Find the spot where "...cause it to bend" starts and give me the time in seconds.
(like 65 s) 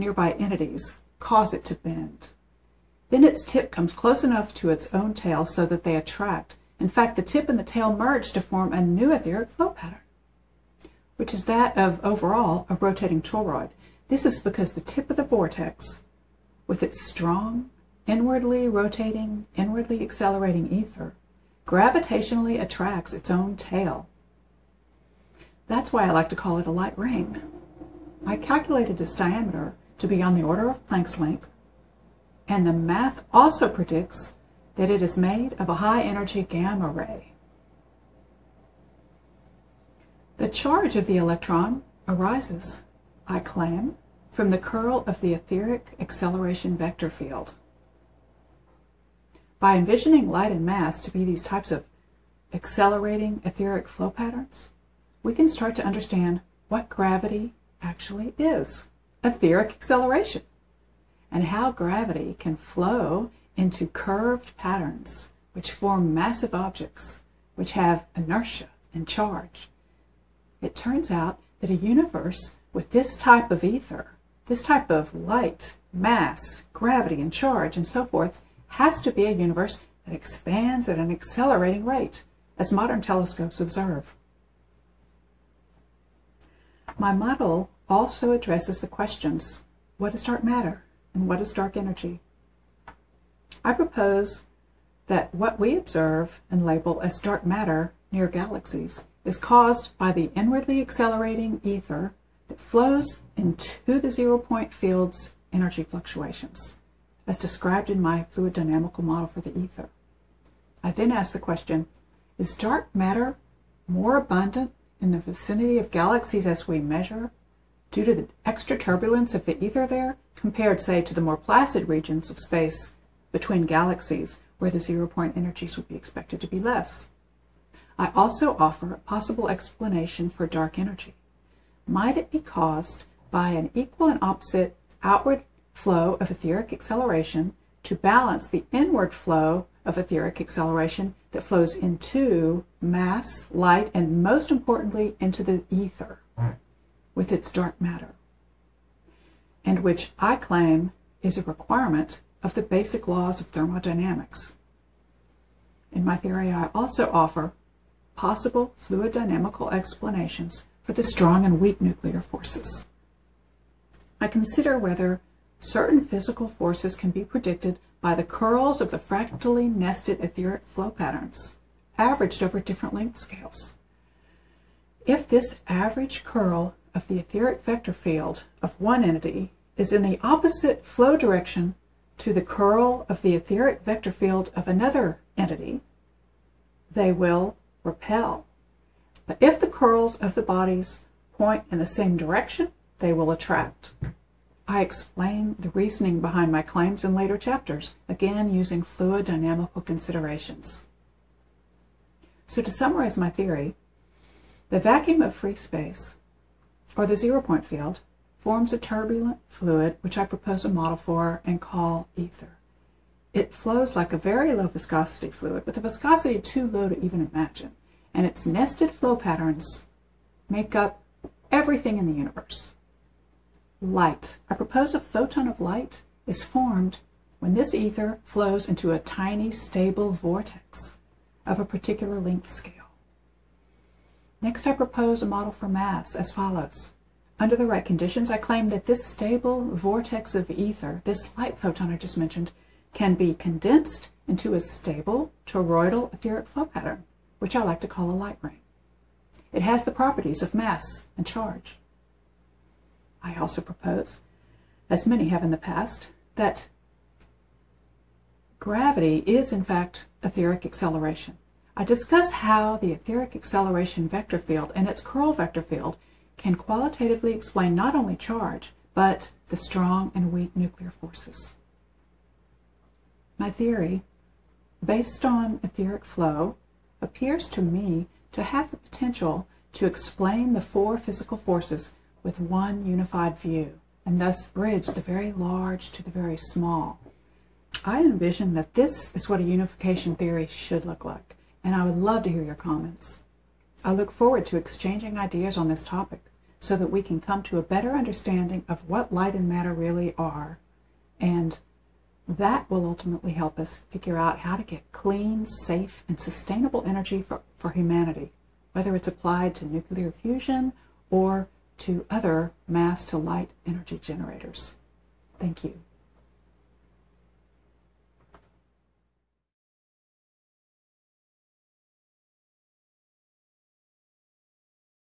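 1 s.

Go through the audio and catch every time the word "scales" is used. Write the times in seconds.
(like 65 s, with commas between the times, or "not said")
173 s, 232 s.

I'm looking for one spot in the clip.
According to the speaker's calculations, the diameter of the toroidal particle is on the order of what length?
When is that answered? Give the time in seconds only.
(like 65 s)
30 s.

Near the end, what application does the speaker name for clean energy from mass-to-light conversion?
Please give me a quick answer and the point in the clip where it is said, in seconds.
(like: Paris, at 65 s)
nuclear fusion, at 309 s.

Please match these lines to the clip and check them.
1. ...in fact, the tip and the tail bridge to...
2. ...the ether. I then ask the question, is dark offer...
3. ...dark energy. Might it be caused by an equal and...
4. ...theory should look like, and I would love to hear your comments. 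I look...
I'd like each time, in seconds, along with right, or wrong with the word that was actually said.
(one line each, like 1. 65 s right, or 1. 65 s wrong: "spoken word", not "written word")
1. 6 s wrong: "merge", not "bridge"
2. 109 s wrong: "matter", not "offer"
3. 130 s right
4. 290 s right.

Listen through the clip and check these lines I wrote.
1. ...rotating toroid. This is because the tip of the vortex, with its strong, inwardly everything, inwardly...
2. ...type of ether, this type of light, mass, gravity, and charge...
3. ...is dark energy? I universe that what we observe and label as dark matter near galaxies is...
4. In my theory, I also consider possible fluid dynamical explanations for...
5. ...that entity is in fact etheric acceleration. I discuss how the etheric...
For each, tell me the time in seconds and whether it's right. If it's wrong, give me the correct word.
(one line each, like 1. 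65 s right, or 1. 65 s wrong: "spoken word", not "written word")
1. 12 s wrong: "rotating", not "everything"
2. 73 s right
3. 91 s wrong: "propose", not "universe"
4. 155 s wrong: "offer", not "consider"
5. 256 s wrong: "gravity", not "entity".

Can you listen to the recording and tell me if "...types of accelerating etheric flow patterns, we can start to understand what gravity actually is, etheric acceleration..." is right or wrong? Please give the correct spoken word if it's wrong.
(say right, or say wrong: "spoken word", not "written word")
right.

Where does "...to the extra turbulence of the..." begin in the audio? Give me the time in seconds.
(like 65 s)
118 s.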